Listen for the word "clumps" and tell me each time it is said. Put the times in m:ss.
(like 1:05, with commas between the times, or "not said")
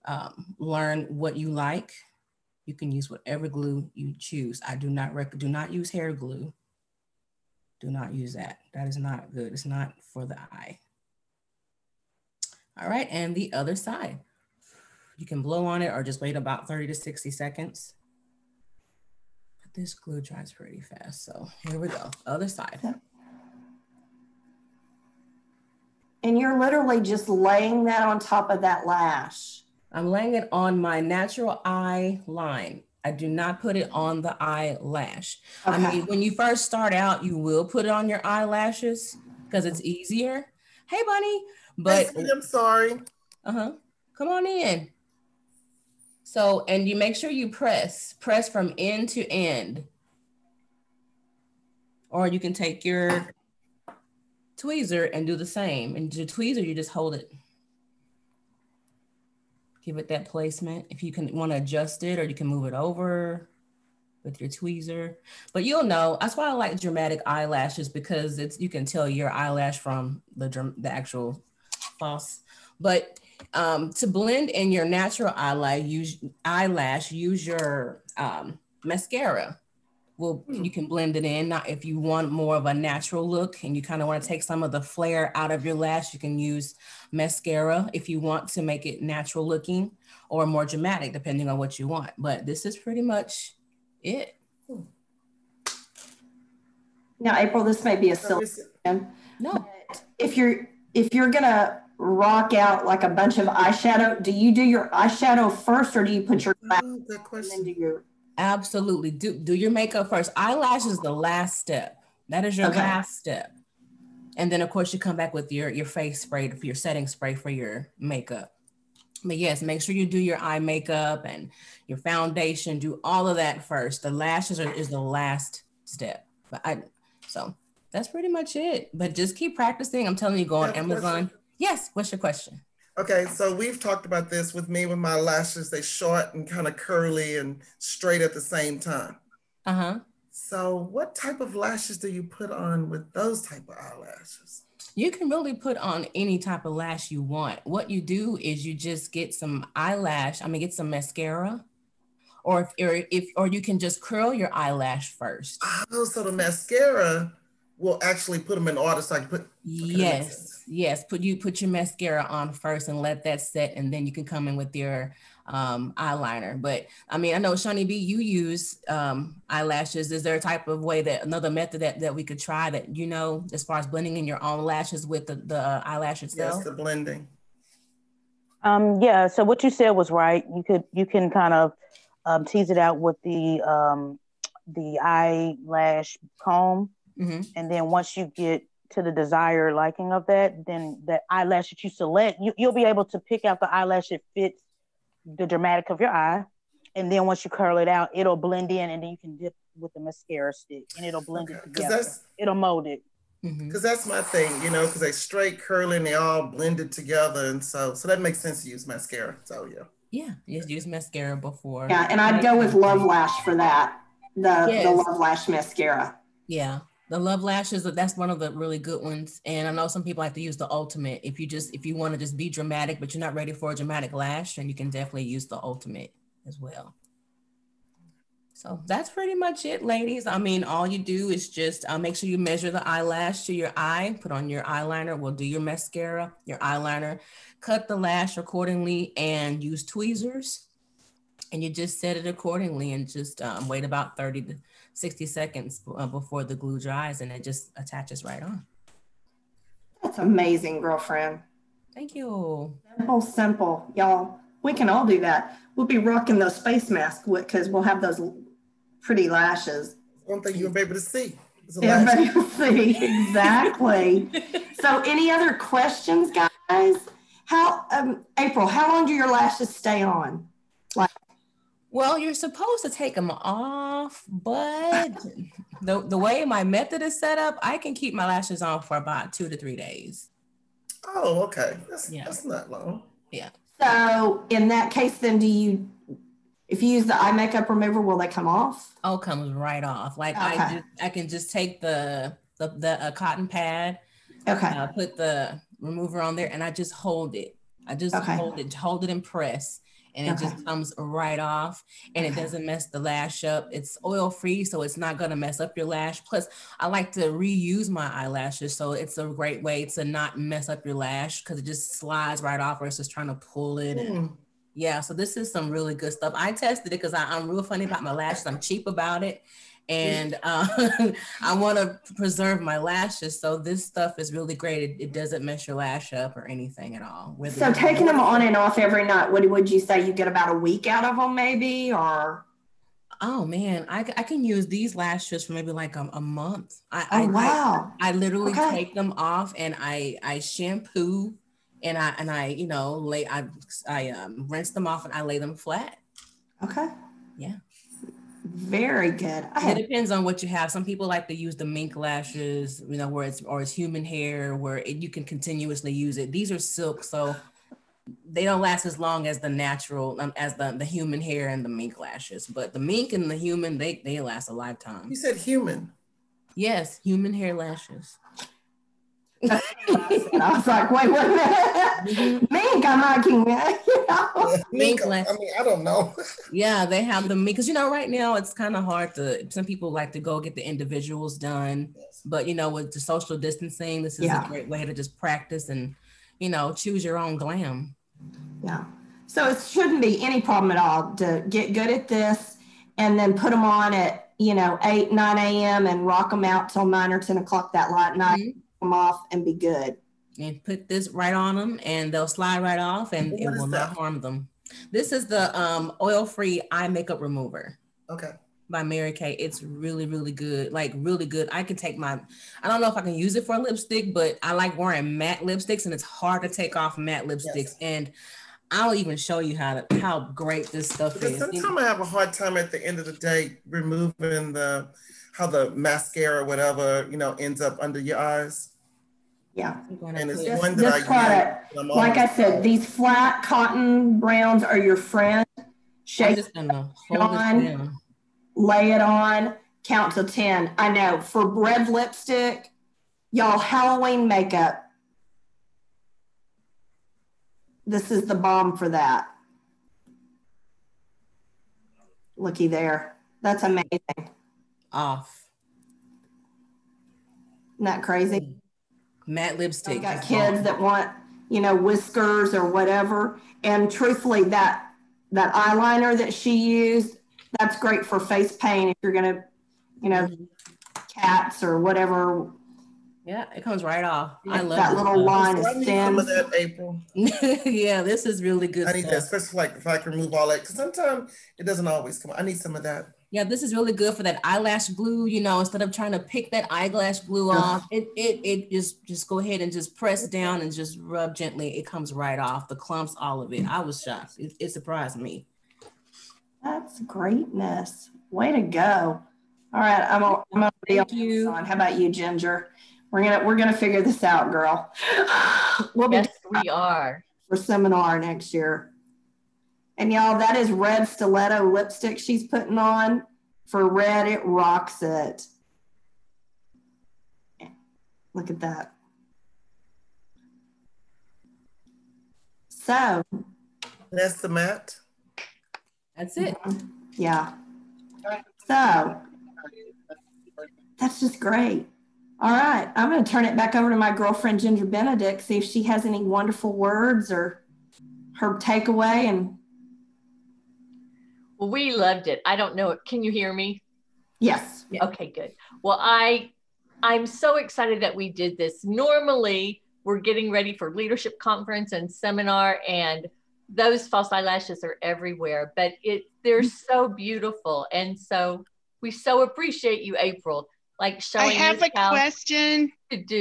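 8:12.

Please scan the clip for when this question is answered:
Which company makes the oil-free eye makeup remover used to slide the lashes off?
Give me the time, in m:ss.
6:48.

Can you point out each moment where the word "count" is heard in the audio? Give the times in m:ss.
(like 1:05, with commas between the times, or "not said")
7:19.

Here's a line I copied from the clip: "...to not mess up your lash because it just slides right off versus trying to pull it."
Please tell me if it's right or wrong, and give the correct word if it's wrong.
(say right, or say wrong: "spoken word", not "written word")
right.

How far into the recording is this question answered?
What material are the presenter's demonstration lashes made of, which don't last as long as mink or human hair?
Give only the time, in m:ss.
5:56.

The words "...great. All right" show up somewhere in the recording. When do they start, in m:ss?
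8:51.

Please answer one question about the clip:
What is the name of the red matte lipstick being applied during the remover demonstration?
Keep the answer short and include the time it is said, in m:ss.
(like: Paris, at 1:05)
red stiletto, at 8:30.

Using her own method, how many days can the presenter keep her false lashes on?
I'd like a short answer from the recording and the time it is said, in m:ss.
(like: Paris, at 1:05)
2 to 3 days, at 4:39.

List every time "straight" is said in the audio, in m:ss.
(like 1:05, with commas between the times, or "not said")
2:17, 3:25.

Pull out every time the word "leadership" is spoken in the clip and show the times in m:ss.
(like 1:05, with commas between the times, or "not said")
9:10.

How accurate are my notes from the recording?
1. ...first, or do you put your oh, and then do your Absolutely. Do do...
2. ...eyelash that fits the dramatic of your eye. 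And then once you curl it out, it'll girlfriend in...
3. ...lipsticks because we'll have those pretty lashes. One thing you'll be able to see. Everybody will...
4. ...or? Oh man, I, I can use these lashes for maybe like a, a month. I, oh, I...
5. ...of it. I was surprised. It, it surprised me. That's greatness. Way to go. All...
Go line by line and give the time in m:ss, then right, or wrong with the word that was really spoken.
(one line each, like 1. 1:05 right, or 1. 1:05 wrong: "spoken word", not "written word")
1. 1:45 right
2. 3:13 wrong: "blend", not "girlfriend"
3. 4:16 wrong: "masks", not "lipsticks"
4. 5:31 right
5. 8:13 wrong: "shocked", not "surprised".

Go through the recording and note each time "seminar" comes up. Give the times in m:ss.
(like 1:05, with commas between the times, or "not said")
8:27, 9:12.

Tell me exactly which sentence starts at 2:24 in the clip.
You can really put on any type of lash you want.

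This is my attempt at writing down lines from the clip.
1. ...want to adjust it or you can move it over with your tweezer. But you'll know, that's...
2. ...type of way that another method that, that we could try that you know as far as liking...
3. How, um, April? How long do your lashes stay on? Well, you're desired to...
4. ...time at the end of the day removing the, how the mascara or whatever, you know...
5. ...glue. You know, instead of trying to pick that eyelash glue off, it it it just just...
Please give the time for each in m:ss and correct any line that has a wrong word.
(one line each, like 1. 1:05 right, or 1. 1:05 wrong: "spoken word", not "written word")
1. 1:01 right
2. 2:50 wrong: "blending", not "liking"
3. 4:27 wrong: "supposed", not "desired"
4. 7:02 right
5. 8:04 right.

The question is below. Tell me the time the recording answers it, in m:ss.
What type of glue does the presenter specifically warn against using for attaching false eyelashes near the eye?
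0:05.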